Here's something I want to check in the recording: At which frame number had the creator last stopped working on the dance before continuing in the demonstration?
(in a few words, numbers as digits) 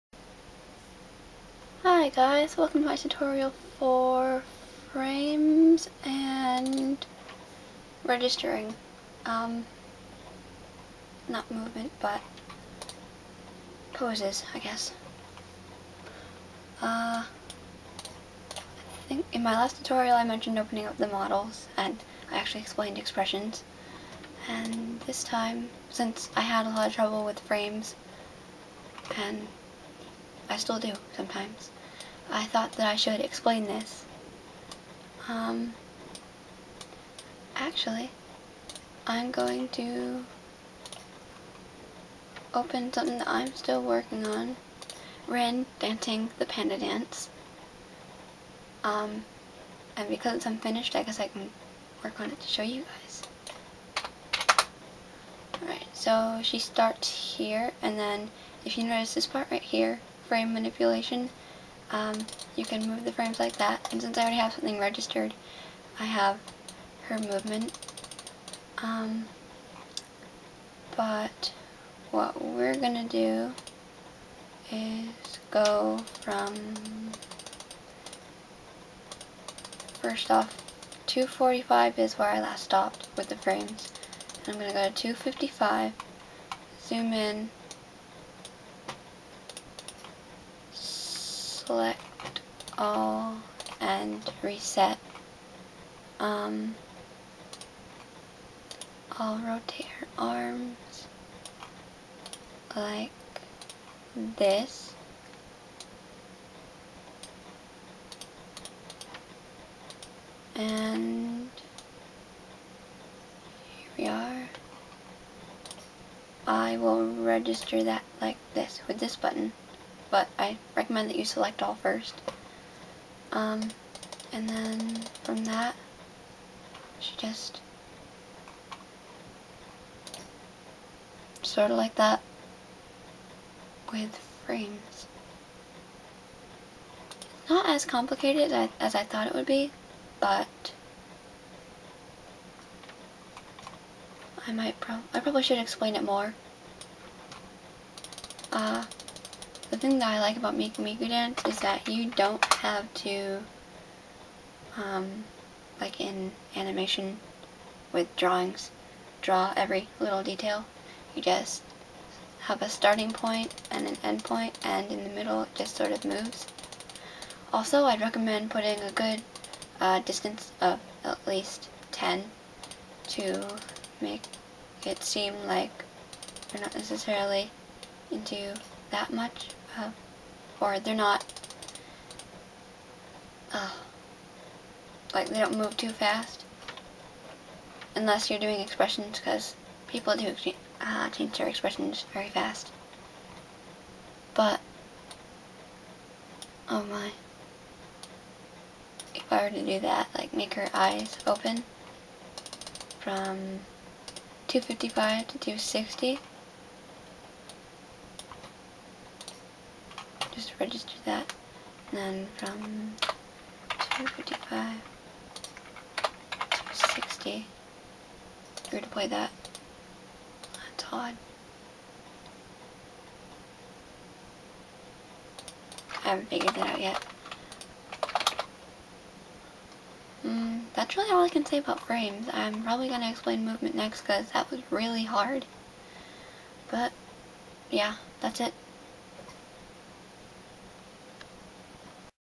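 245.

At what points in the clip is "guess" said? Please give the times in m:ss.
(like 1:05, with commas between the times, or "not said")
0:14, 0:51.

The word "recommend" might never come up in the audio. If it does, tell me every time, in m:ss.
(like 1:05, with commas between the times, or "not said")
2:00, 2:48.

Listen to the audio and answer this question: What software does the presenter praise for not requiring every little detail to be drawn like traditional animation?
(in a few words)
Miku Miku Dance.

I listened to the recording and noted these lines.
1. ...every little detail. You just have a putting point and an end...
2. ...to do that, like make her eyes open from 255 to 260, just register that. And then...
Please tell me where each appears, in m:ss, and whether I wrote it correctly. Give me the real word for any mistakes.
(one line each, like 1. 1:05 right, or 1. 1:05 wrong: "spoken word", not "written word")
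1. 2:39 wrong: "starting", not "putting"
2. 3:19 right.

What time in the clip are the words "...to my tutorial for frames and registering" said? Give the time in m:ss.
0:02.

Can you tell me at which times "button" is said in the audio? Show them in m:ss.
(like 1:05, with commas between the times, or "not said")
1:59.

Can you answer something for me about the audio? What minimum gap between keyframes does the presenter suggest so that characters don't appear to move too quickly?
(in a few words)
10.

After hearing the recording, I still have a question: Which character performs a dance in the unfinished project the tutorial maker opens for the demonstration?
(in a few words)
Ren.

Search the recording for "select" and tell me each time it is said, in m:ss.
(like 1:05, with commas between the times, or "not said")
1:31, 2:01.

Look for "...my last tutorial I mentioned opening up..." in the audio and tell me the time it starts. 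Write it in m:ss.
0:19.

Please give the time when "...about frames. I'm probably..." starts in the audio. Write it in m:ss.
3:51.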